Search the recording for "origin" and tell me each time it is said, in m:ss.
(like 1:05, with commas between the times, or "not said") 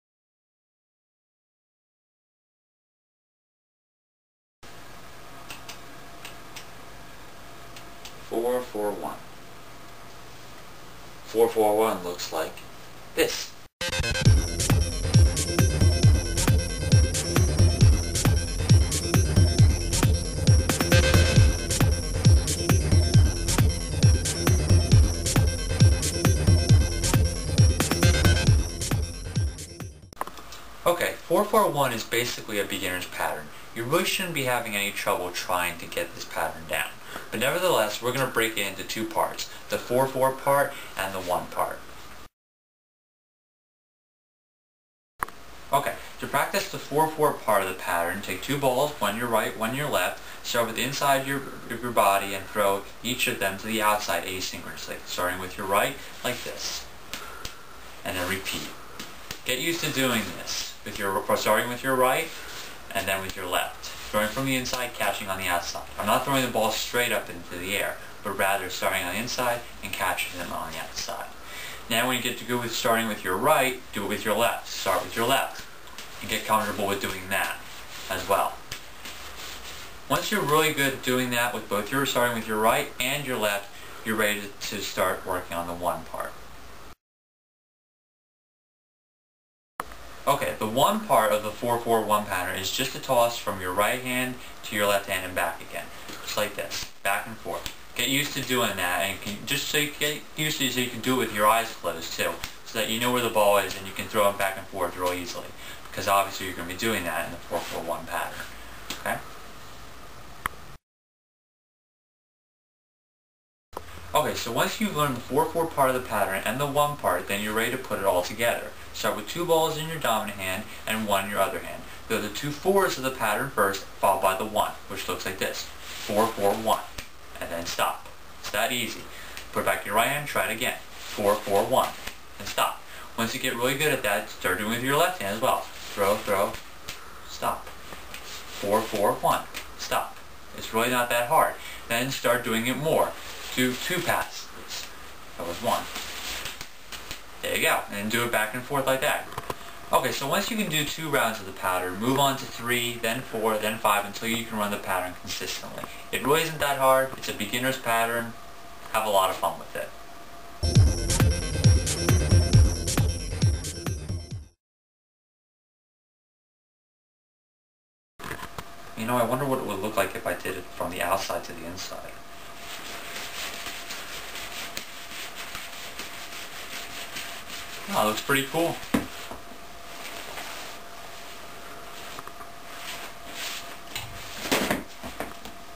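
not said.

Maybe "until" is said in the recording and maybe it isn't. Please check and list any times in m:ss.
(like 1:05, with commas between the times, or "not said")
2:34.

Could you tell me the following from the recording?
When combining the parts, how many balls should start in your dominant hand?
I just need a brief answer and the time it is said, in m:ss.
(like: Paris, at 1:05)
2, at 1:59.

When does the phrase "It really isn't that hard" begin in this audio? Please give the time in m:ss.
2:36.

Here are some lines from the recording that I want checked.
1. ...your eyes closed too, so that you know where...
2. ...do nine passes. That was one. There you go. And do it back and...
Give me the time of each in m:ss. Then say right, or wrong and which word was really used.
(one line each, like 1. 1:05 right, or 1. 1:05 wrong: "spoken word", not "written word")
1. 1:41 right
2. 2:23 wrong: "two", not "nine".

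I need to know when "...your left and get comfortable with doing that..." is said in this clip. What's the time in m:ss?
1:15.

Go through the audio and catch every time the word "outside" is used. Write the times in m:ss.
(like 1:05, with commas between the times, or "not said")
0:53, 1:05, 1:10, 2:51.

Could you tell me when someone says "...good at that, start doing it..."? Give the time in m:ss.
2:13.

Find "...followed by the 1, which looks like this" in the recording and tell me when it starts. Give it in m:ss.
2:03.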